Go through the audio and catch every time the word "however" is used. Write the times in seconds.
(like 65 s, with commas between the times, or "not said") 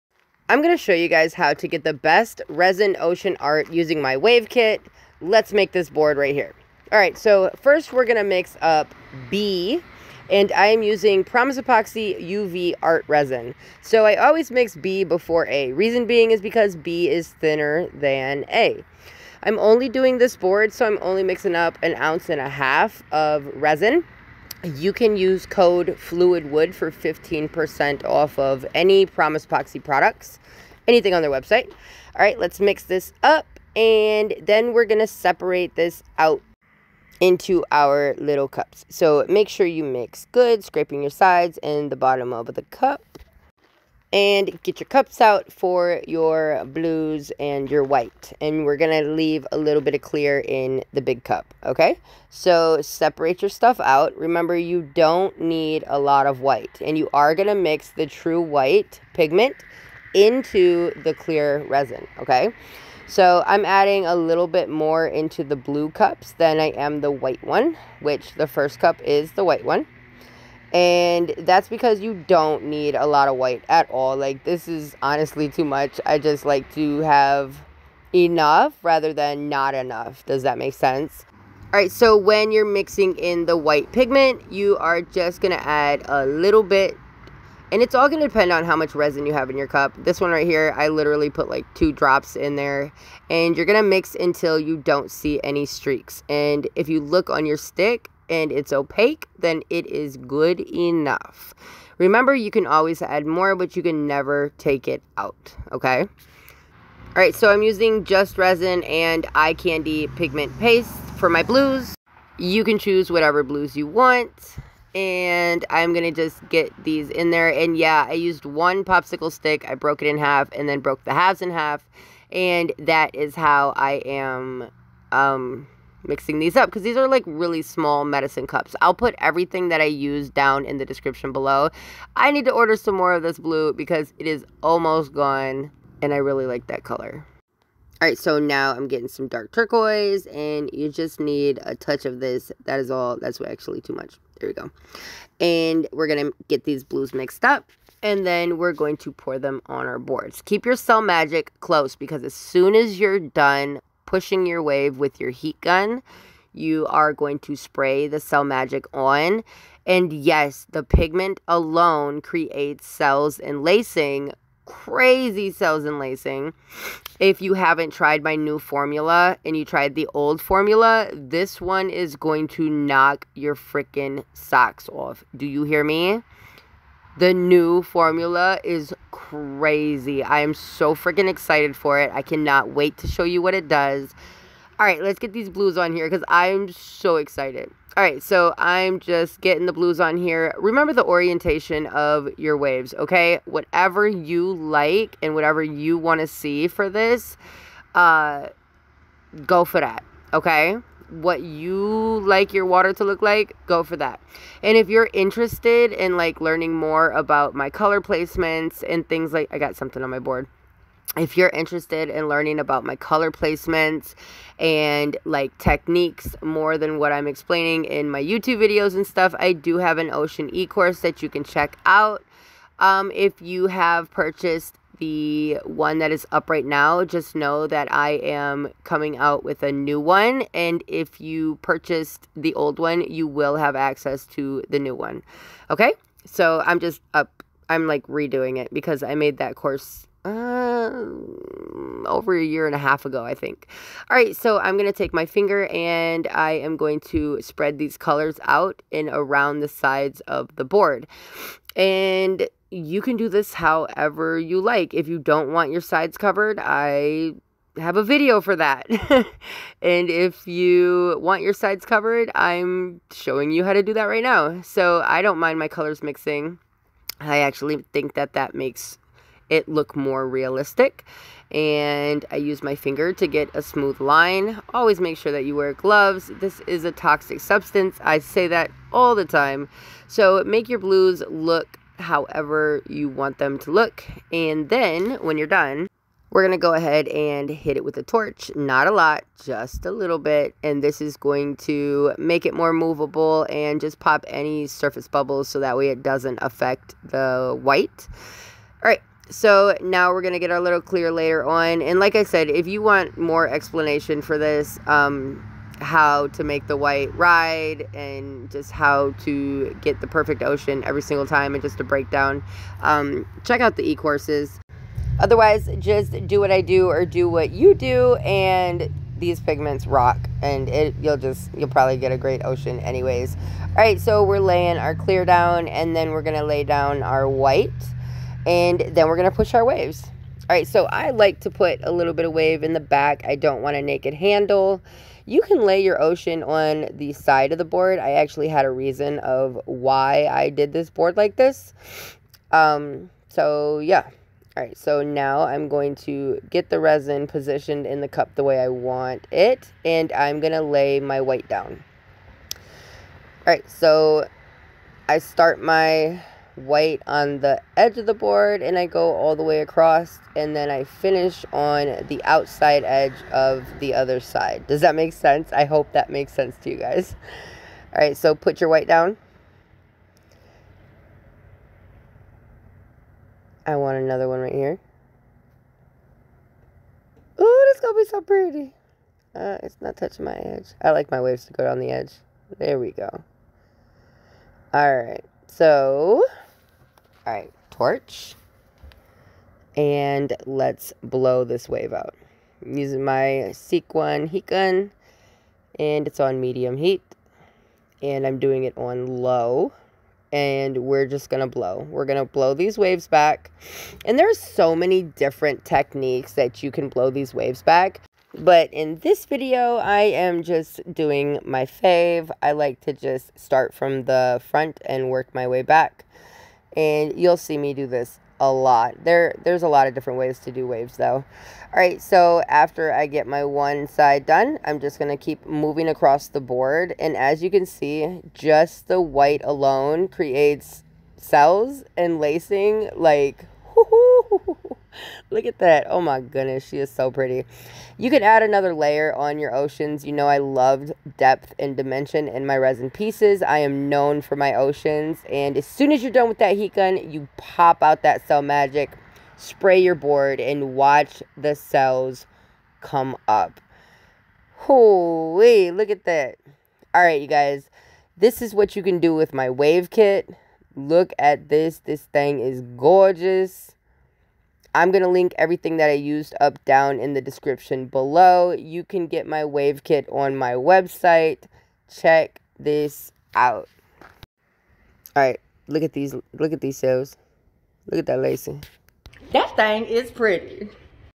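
253 s, 282 s.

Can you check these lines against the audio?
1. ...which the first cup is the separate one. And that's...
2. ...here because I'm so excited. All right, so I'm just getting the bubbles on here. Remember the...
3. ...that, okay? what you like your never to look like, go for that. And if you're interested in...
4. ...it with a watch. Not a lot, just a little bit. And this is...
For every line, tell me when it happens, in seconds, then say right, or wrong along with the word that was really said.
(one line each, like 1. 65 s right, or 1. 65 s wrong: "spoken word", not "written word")
1. 68 s wrong: "white", not "separate"
2. 185 s wrong: "blues", not "bubbles"
3. 199 s wrong: "water", not "never"
4. 287 s wrong: "torch", not "watch".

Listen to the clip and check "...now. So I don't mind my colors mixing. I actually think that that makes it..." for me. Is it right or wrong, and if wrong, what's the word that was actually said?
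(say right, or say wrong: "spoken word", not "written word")
right.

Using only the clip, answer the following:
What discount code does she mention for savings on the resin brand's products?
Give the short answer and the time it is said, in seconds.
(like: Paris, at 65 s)
FLUIDWOOD, at 25 s.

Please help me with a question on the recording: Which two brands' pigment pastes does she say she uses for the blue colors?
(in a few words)
Just Resin and Eye Candy.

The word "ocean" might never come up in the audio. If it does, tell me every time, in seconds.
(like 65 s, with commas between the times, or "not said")
2 s, 220 s, 310 s, 322 s, 336 s, 439 s, 444 s.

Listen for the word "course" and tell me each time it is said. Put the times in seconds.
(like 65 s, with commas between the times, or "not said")
220 s, 239 s, 313 s.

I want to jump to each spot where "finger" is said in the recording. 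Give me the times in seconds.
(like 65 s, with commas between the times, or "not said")
245 s, 272 s.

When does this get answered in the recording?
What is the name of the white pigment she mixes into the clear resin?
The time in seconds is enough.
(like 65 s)
58 s.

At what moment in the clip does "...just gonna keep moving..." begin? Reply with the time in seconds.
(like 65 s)
424 s.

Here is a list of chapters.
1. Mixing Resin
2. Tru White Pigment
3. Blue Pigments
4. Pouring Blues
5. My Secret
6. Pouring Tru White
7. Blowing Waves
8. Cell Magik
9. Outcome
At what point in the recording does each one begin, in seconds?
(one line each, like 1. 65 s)
1. 11 s
2. 48 s
3. 114 s
4. 172 s
5. 301 s
6. 331 s
7. 391 s
8. 440 s
9. 459 s.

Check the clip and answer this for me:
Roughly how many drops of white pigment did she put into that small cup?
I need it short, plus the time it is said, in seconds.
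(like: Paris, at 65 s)
2, at 91 s.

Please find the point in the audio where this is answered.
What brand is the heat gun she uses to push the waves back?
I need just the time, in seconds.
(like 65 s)
393 s.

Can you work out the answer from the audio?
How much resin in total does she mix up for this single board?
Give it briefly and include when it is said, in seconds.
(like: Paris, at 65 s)
An ounce and a half, at 21 s.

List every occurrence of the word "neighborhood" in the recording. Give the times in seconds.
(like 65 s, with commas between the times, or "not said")
not said.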